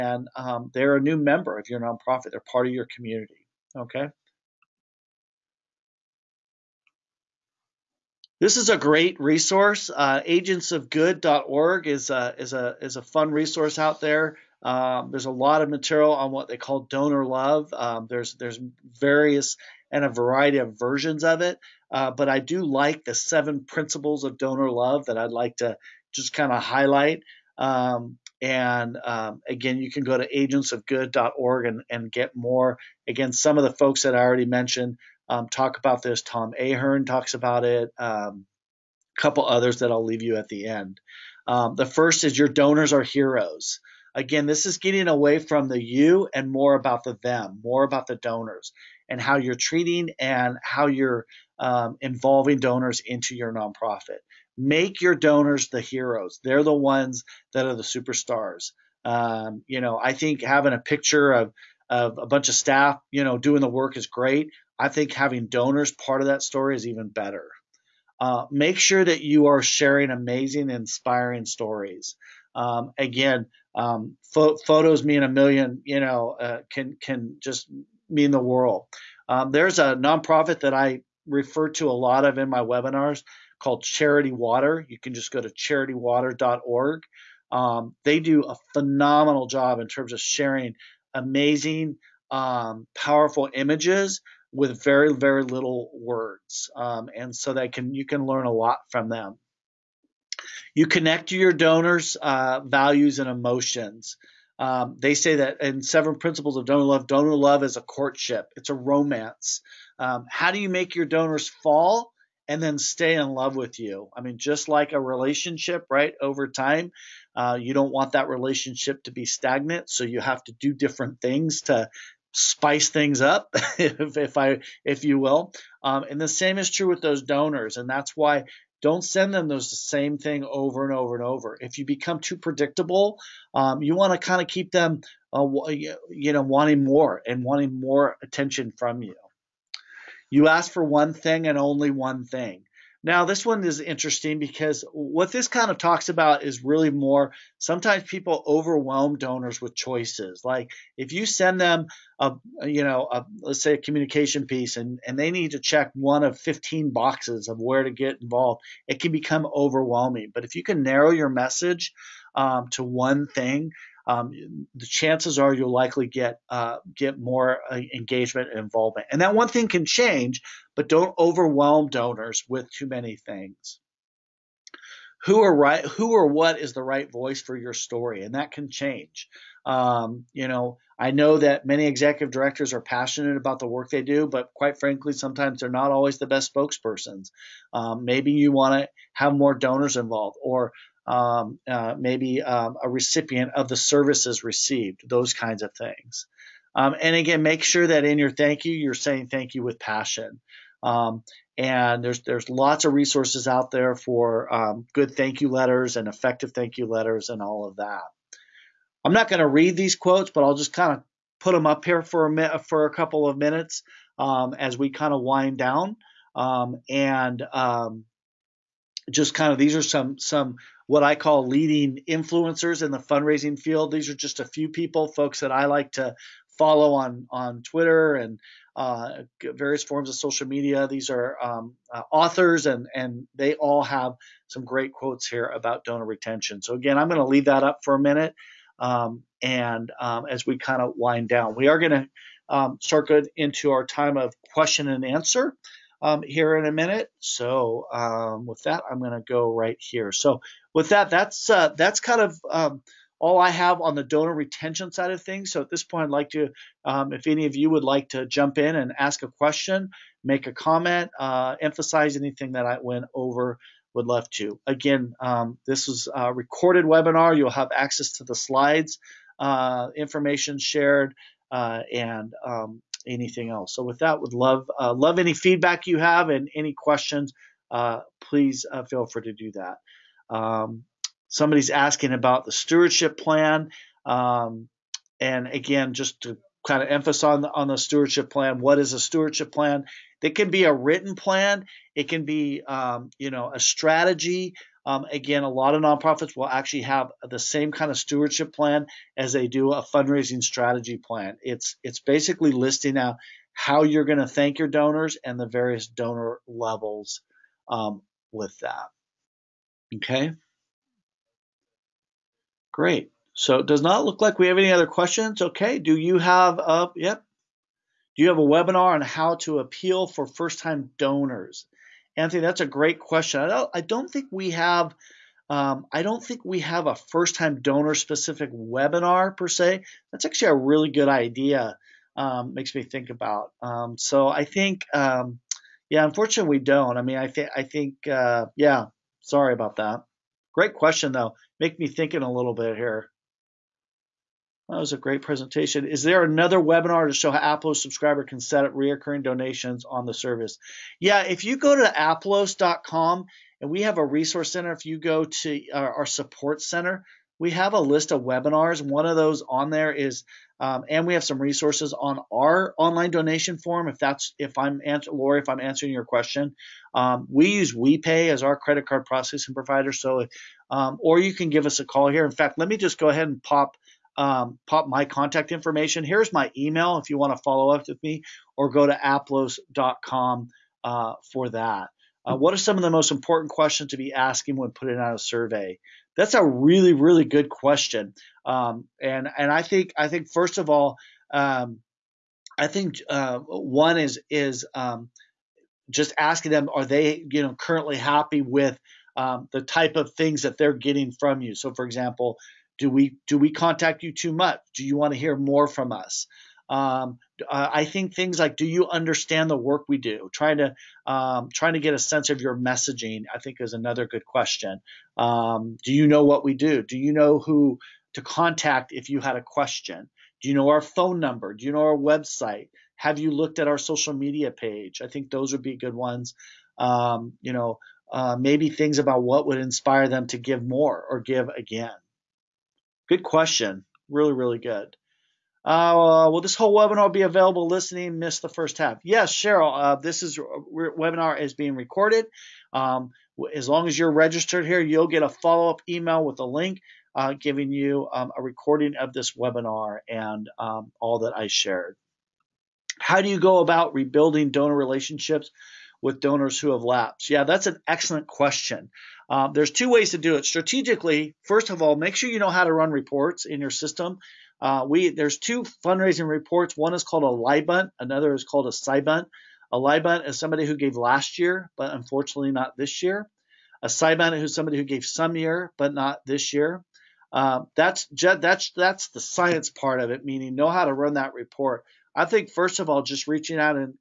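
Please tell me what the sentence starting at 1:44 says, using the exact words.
Um, they say that in seven principles of donor love, donor love is a courtship, it's a romance.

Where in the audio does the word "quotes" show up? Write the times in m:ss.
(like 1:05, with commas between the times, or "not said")
3:29, 3:54.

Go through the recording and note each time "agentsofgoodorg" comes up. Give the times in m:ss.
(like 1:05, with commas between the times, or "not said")
0:10, 0:30.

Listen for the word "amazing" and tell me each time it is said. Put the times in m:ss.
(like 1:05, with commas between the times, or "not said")
1:10, 1:31.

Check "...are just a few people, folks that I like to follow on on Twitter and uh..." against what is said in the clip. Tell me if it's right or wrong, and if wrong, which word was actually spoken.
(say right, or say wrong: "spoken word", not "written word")
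right.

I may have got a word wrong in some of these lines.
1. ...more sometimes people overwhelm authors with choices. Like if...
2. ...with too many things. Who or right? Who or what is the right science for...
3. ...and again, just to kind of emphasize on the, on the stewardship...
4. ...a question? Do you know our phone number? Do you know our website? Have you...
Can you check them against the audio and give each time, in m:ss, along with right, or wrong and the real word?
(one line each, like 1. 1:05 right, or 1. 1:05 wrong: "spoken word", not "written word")
1. 2:26 wrong: "donors", not "authors"
2. 2:52 wrong: "voice", not "science"
3. 4:45 right
4. 6:59 right.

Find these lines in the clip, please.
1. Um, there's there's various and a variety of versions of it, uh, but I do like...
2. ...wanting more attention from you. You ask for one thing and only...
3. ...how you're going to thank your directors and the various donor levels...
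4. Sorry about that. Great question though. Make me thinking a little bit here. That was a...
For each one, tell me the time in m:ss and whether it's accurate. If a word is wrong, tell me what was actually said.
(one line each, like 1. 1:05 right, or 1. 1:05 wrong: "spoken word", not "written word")
1. 0:17 right
2. 2:17 right
3. 5:03 wrong: "donors", not "directors"
4. 5:39 right.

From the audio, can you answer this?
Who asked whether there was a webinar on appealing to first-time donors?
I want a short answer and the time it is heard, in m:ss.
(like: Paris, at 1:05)
Anthony, at 5:22.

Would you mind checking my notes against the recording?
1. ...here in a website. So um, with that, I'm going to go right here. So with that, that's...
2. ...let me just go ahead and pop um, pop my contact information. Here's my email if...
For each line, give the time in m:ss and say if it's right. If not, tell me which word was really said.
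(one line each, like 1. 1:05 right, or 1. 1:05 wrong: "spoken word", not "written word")
1. 4:06 wrong: "minute", not "website"
2. 6:12 right.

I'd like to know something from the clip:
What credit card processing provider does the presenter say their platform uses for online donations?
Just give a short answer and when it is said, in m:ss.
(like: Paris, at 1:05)
WePay, at 6:07.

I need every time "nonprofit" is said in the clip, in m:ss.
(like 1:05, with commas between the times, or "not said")
0:01, 0:53, 1:19, 4:55.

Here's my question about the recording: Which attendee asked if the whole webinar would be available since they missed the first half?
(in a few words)
Cheryl.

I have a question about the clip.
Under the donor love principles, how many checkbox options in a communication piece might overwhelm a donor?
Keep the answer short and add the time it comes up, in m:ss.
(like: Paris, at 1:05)
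15, at 2:36.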